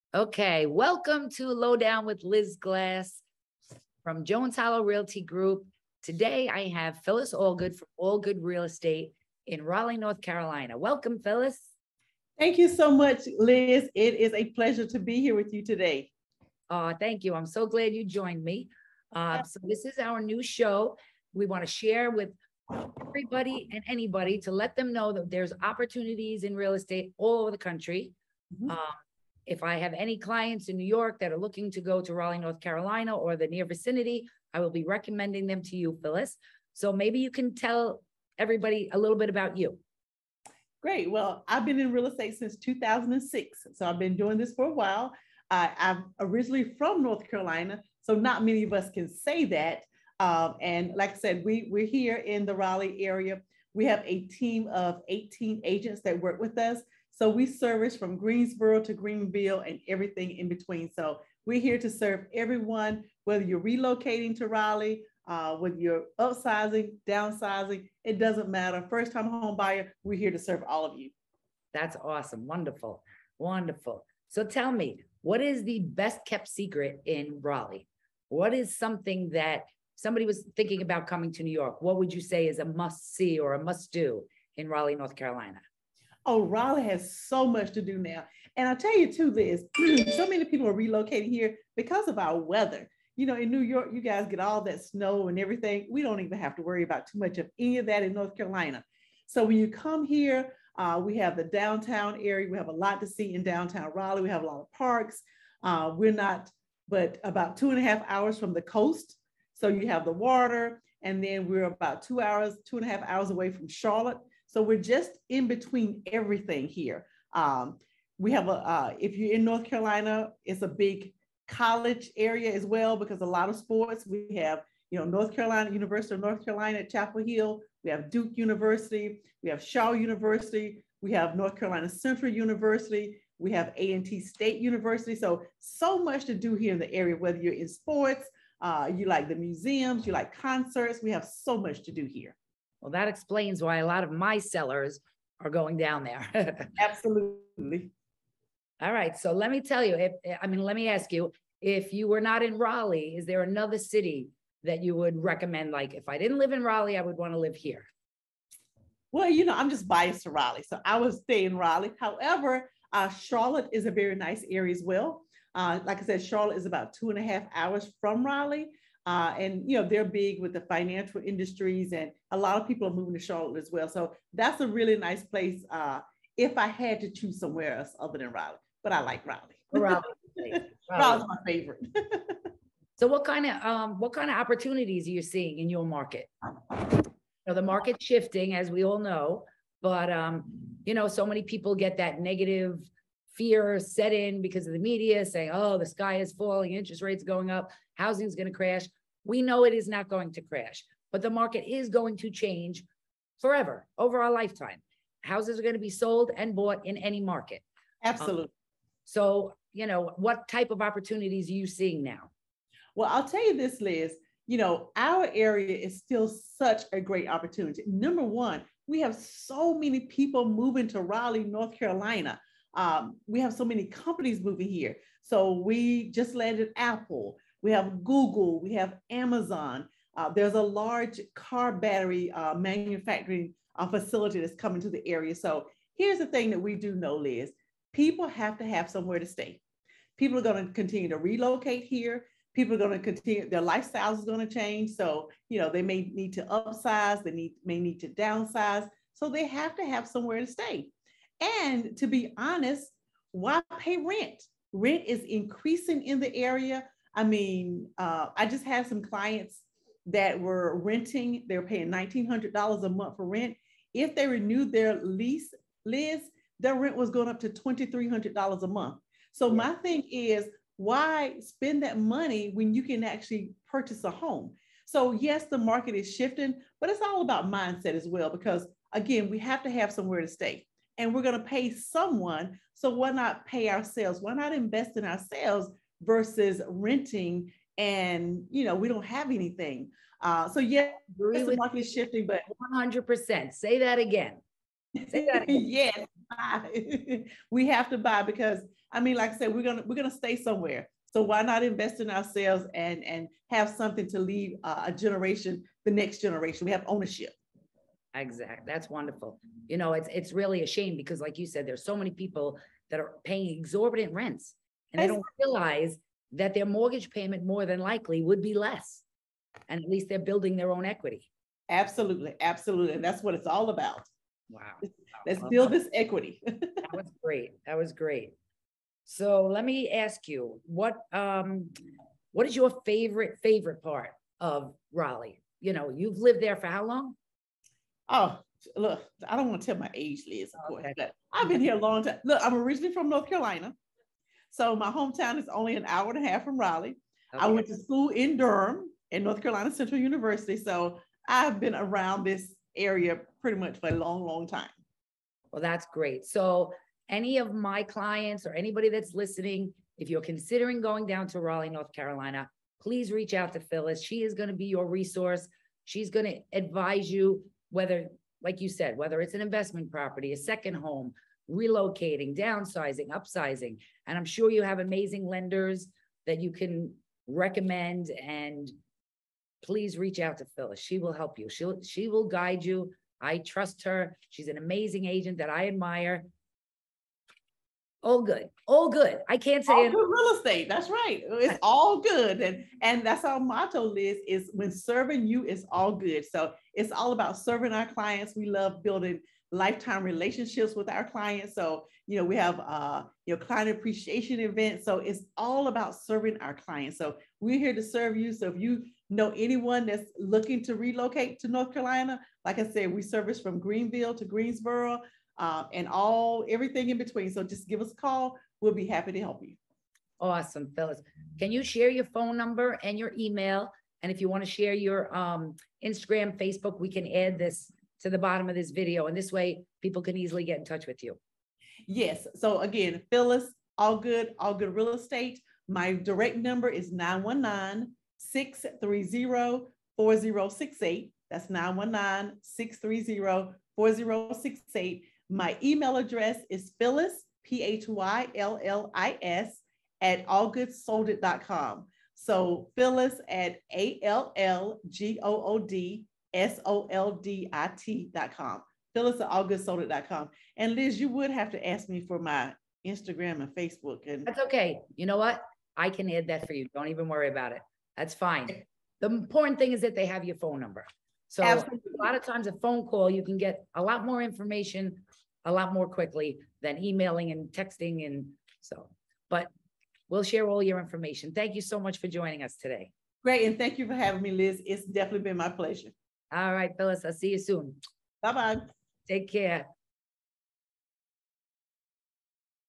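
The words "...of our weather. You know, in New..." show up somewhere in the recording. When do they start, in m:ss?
1:32.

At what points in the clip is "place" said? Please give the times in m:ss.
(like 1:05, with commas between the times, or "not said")
2:55.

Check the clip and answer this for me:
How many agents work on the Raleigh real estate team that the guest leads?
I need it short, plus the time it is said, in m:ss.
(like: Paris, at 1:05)
18, at 0:55.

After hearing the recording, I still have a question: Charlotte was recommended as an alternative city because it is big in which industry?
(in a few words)
financial.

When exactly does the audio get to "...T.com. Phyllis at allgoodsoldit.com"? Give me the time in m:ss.
7:37.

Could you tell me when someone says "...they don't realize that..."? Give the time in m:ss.
5:15.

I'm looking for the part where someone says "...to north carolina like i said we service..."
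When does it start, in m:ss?
6:51.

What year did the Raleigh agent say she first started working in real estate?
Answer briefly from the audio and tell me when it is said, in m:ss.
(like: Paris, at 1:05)
2006, at 0:42.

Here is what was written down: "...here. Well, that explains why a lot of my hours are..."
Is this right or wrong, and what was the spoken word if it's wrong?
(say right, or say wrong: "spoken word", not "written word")
wrong: "sellers", not "hours".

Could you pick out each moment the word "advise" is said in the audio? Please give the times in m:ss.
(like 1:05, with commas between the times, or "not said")
6:06.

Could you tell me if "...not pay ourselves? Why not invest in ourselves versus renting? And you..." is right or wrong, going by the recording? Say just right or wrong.
right.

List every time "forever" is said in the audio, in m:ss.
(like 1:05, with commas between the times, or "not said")
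3:23.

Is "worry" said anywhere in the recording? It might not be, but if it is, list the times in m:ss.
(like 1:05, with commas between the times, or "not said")
1:36, 7:47.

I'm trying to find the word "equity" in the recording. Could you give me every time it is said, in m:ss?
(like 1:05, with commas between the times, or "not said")
5:20, 5:25.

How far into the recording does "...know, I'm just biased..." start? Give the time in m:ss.
2:39.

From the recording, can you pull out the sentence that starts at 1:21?
What would you say is a must see or a must do in Raleigh, North Carolina?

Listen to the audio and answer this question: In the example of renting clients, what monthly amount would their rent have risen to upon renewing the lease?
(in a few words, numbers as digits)
$2,300.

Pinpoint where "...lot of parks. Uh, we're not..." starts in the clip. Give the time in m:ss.
1:44.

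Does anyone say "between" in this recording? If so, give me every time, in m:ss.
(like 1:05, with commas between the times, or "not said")
1:00, 1:55, 6:56.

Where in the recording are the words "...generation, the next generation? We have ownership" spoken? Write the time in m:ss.
5:04.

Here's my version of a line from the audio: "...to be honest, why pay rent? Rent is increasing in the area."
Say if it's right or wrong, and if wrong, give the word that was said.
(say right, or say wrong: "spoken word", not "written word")
right.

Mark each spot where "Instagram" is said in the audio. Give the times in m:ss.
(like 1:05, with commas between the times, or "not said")
7:05, 7:42.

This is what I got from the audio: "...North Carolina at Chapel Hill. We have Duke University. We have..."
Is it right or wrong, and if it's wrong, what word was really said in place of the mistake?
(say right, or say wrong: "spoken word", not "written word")
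right.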